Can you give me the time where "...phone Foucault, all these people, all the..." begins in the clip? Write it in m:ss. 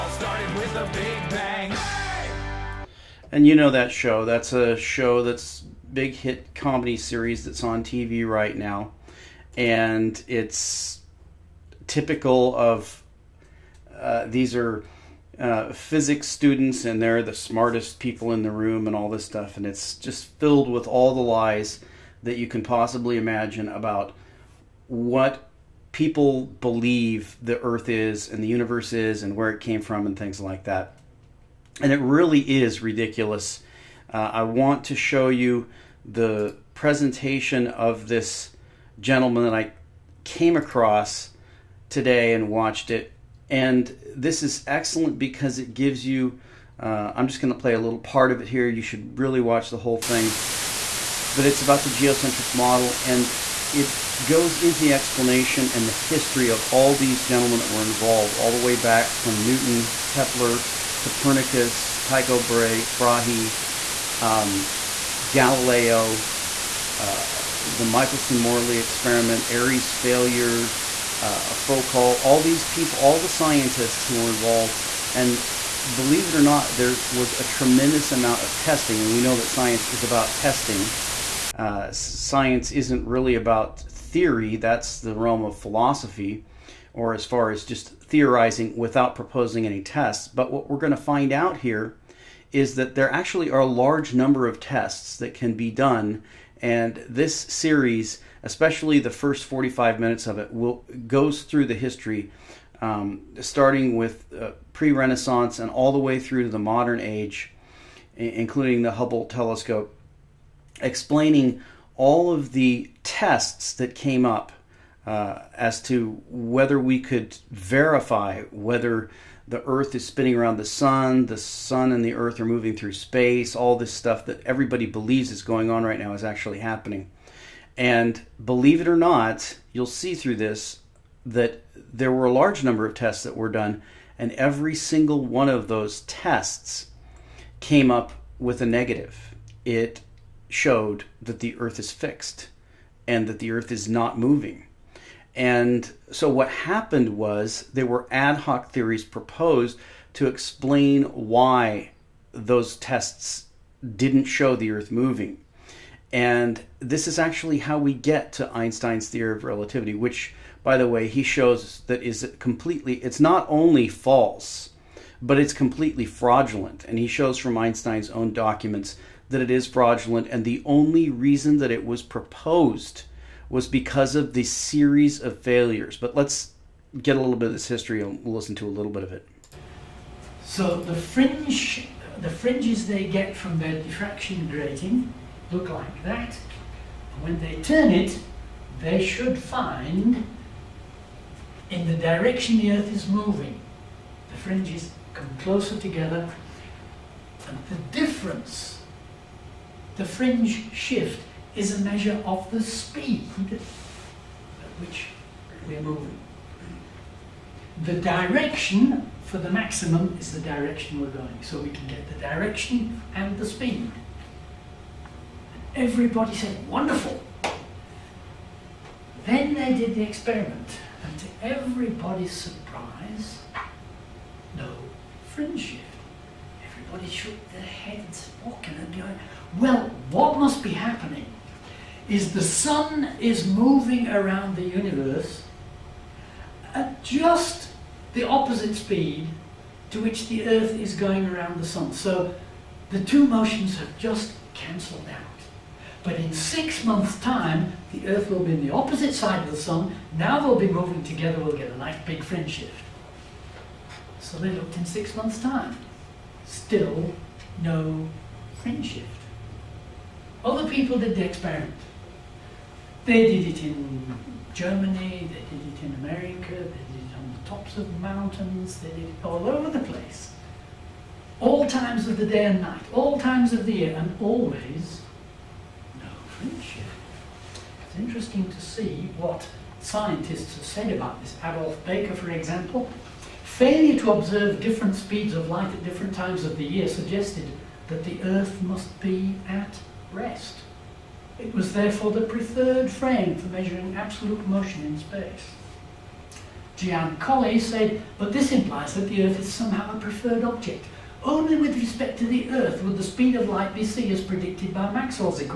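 1:11.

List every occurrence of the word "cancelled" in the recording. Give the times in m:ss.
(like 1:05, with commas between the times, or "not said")
4:04.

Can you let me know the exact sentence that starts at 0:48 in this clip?
You should really watch the whole thing.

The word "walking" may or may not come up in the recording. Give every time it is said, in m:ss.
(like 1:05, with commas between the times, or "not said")
3:48.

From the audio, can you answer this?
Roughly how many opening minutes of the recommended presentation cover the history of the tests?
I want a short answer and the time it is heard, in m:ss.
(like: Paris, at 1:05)
45, at 1:39.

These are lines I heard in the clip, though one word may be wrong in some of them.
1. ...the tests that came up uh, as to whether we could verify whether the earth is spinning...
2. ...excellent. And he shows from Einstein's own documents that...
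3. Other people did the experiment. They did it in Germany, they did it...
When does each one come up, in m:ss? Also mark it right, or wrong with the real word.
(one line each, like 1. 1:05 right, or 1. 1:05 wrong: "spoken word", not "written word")
1. 1:52 right
2. 2:46 wrong: "fraudulent", not "excellent"
3. 4:20 right.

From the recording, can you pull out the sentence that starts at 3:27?
The direction for the maximum is the direction we're going, so we can get the direction and the speed.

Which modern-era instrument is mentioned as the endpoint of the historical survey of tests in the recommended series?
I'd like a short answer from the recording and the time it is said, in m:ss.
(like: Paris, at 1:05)
Hubble telescope, at 1:48.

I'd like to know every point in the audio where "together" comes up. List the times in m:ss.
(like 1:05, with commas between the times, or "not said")
3:15, 4:11.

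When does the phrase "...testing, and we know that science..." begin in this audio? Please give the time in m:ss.
1:18.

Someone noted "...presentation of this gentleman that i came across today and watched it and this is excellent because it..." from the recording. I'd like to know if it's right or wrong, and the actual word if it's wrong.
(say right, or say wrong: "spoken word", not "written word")
right.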